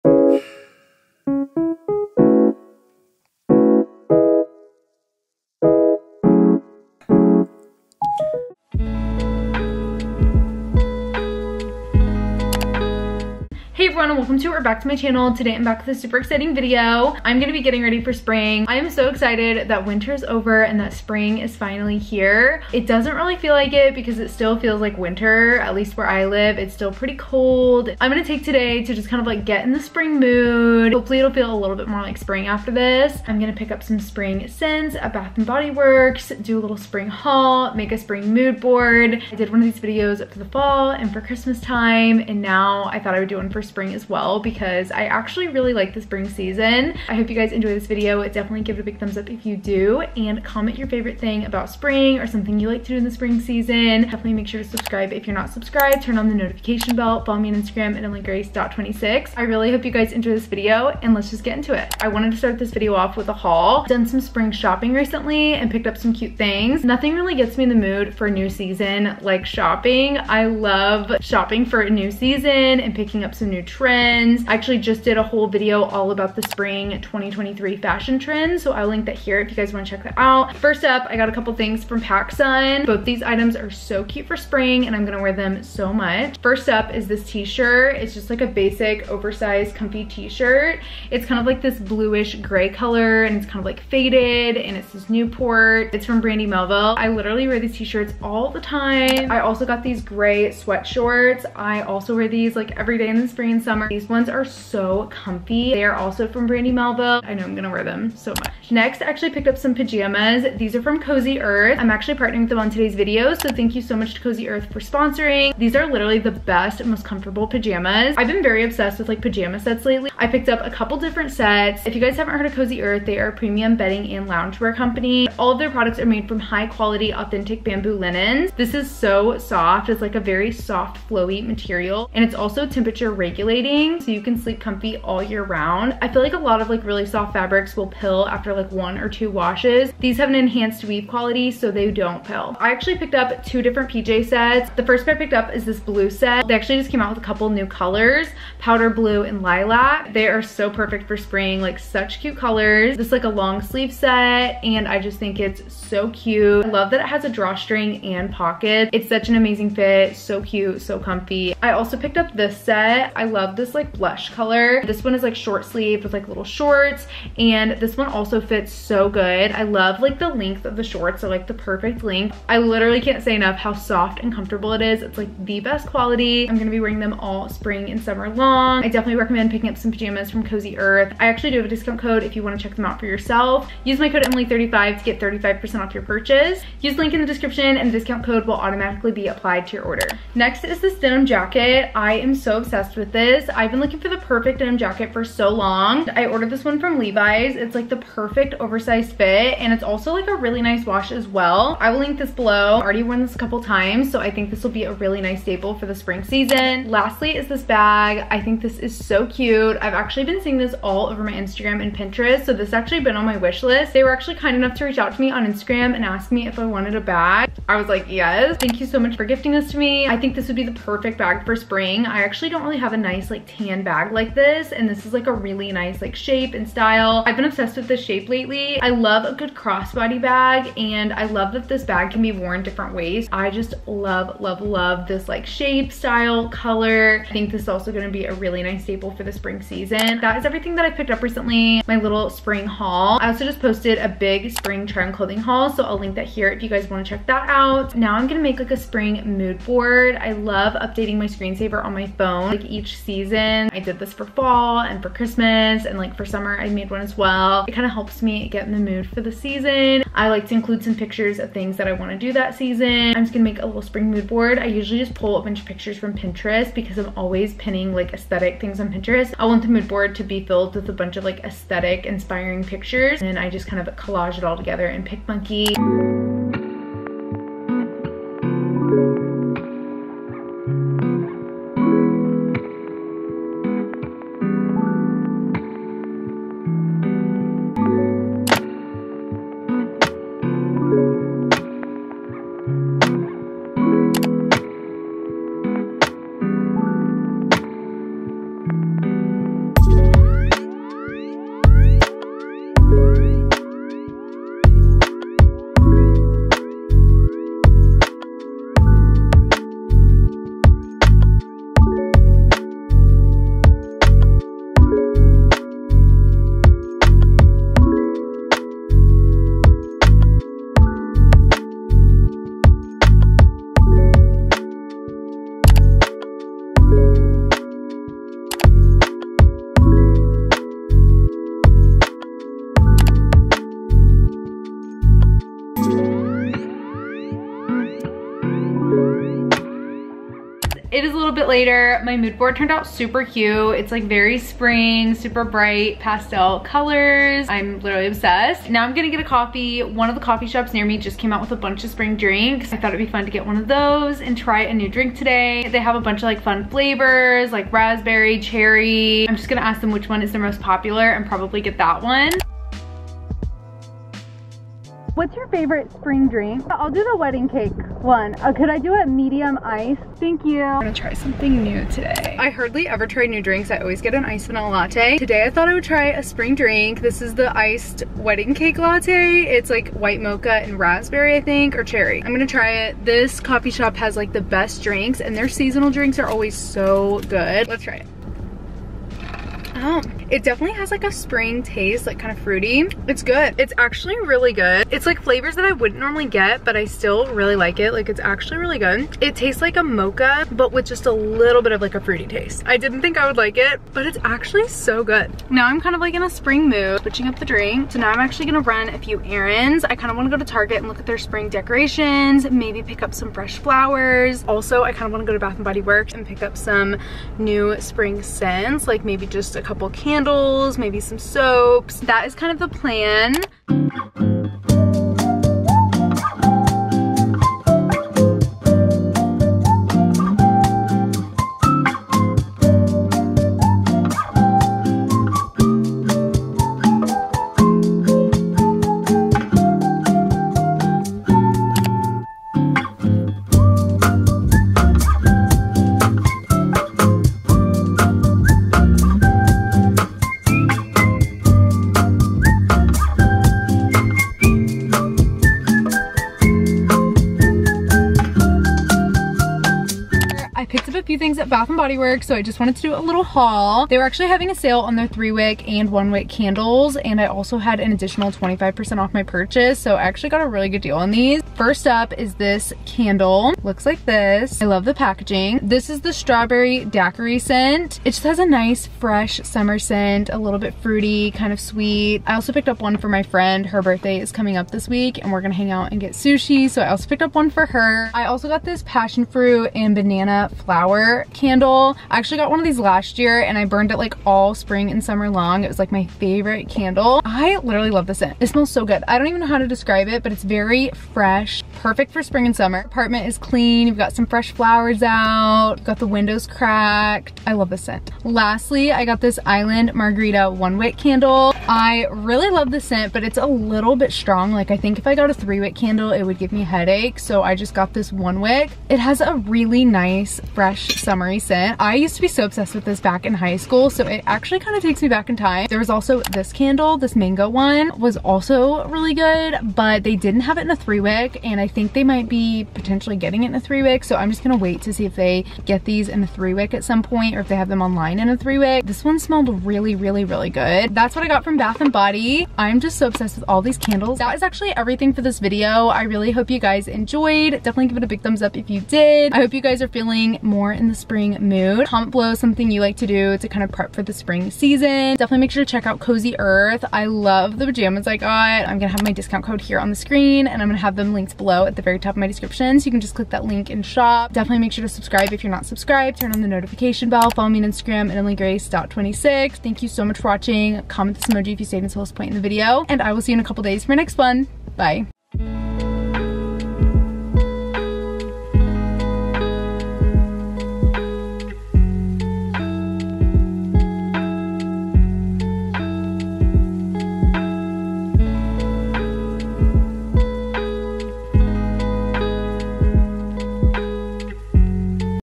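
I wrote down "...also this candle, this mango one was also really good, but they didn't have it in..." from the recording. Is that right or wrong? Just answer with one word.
right.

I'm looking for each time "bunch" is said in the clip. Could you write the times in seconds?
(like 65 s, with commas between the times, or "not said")
265 s, 270 s, 351 s, 356 s.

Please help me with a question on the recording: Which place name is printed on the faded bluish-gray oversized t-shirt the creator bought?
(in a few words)
Newport.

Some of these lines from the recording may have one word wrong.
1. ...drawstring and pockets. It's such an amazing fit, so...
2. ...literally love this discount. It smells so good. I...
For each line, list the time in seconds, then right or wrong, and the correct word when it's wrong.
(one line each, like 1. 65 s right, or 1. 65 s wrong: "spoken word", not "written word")
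1. 157 s right
2. 497 s wrong: "scent", not "discount".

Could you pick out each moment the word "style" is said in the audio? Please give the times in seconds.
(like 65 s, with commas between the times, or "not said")
226 s, 235 s.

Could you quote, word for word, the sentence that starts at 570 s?
Comment this emoji if you stayed until this point in the video.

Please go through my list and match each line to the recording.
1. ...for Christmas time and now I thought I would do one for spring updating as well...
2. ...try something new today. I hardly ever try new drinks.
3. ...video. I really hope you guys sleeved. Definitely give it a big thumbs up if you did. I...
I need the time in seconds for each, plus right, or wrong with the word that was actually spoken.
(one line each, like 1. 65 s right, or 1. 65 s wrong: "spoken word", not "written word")
1. 41 s wrong: "spring", not "updating"
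2. 370 s right
3. 545 s wrong: "enjoyed", not "sleeved".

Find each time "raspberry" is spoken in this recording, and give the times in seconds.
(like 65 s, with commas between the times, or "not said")
357 s, 380 s.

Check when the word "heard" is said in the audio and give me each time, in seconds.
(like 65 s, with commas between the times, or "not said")
122 s.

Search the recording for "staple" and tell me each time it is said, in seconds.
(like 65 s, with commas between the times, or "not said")
205 s, 238 s.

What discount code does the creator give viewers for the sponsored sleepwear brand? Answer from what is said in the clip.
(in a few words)
Emily35.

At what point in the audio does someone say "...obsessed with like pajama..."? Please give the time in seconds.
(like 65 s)
118 s.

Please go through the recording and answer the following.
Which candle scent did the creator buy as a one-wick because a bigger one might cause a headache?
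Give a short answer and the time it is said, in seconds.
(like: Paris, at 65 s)
Island Margarita, at 509 s.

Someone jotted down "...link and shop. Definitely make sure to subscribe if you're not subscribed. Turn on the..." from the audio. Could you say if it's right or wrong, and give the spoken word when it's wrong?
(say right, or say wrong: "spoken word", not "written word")
right.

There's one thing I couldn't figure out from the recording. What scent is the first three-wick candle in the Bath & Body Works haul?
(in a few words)
strawberry daiquiri.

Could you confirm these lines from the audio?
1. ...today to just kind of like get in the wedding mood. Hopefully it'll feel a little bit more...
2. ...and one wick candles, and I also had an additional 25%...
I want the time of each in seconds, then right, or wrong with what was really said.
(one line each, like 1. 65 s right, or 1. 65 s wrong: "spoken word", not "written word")
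1. 28 s wrong: "spring", not "wedding"
2. 465 s right.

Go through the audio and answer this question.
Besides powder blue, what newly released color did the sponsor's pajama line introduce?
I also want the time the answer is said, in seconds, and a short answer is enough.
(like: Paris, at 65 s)
lilac, at 149 s.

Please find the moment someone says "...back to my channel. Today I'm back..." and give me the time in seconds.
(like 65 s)
14 s.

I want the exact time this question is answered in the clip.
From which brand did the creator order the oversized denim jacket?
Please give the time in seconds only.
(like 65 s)
196 s.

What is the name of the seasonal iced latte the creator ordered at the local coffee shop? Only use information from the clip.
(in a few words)
wedding cake latte.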